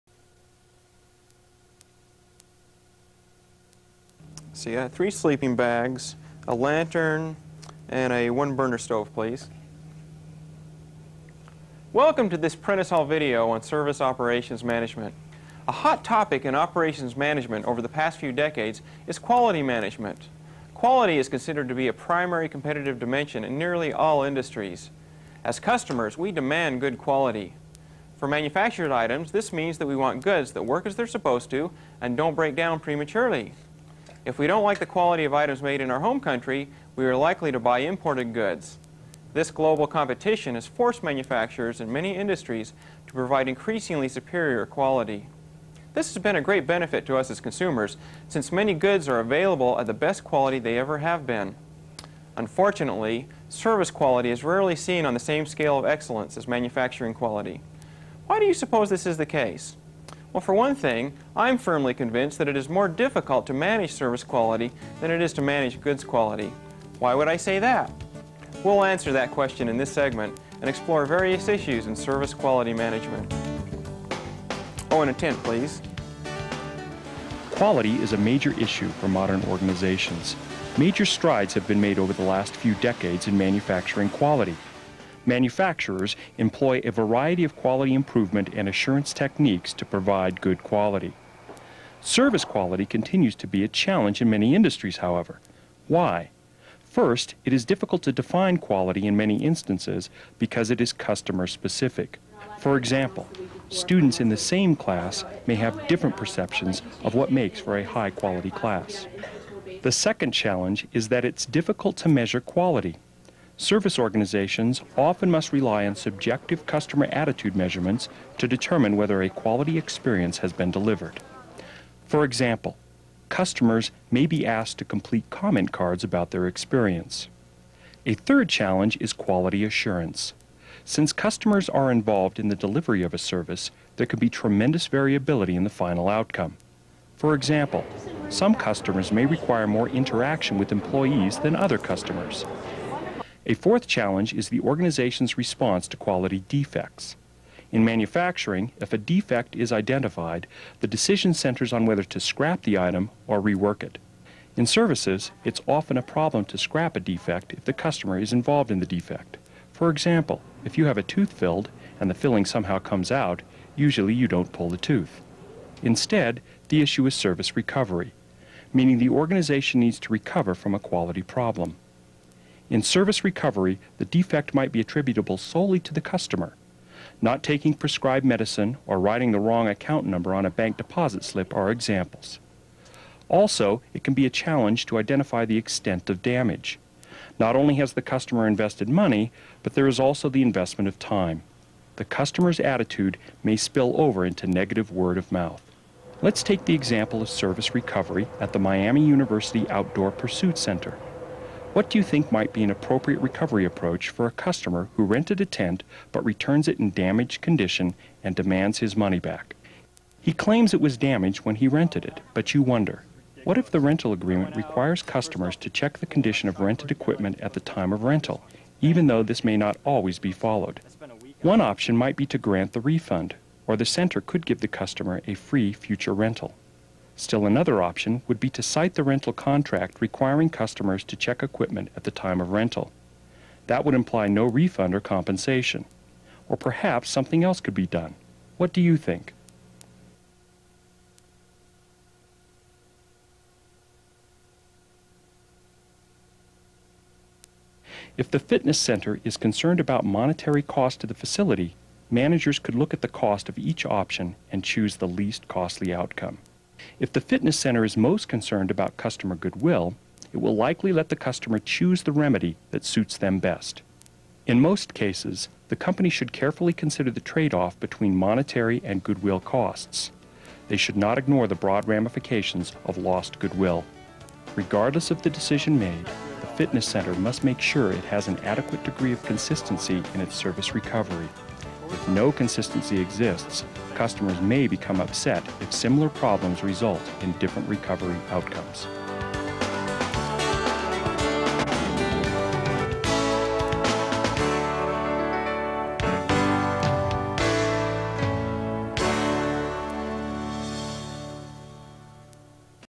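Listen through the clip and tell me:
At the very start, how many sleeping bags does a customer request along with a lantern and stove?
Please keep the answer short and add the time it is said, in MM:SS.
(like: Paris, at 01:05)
3, at 00:04.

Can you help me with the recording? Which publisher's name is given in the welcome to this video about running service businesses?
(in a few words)
Prentice Hall.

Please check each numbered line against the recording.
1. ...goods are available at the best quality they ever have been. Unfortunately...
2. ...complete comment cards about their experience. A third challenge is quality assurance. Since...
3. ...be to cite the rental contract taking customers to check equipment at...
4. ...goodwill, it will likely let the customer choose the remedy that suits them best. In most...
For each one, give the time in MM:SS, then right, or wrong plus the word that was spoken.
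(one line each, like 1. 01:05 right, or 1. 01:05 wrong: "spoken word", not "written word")
1. 00:48 right
2. 02:04 right
3. 03:48 wrong: "requiring", not "taking"
4. 04:19 right.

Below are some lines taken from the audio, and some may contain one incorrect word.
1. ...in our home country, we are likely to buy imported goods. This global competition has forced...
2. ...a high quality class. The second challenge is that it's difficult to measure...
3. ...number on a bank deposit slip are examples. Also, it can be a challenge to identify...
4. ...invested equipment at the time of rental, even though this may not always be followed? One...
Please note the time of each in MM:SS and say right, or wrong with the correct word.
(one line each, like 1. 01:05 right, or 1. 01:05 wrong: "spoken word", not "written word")
1. 00:35 right
2. 01:47 right
3. 03:00 right
4. 03:36 wrong: "rented", not "invested".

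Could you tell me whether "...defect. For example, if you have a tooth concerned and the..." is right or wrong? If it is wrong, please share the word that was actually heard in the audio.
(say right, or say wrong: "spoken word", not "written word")
wrong: "filled", not "concerned".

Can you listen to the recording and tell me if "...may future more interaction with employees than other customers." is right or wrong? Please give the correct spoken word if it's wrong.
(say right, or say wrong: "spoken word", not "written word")
wrong: "require", not "future".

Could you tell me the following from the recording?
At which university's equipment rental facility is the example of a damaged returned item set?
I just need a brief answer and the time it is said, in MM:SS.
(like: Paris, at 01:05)
Miami University, at 03:18.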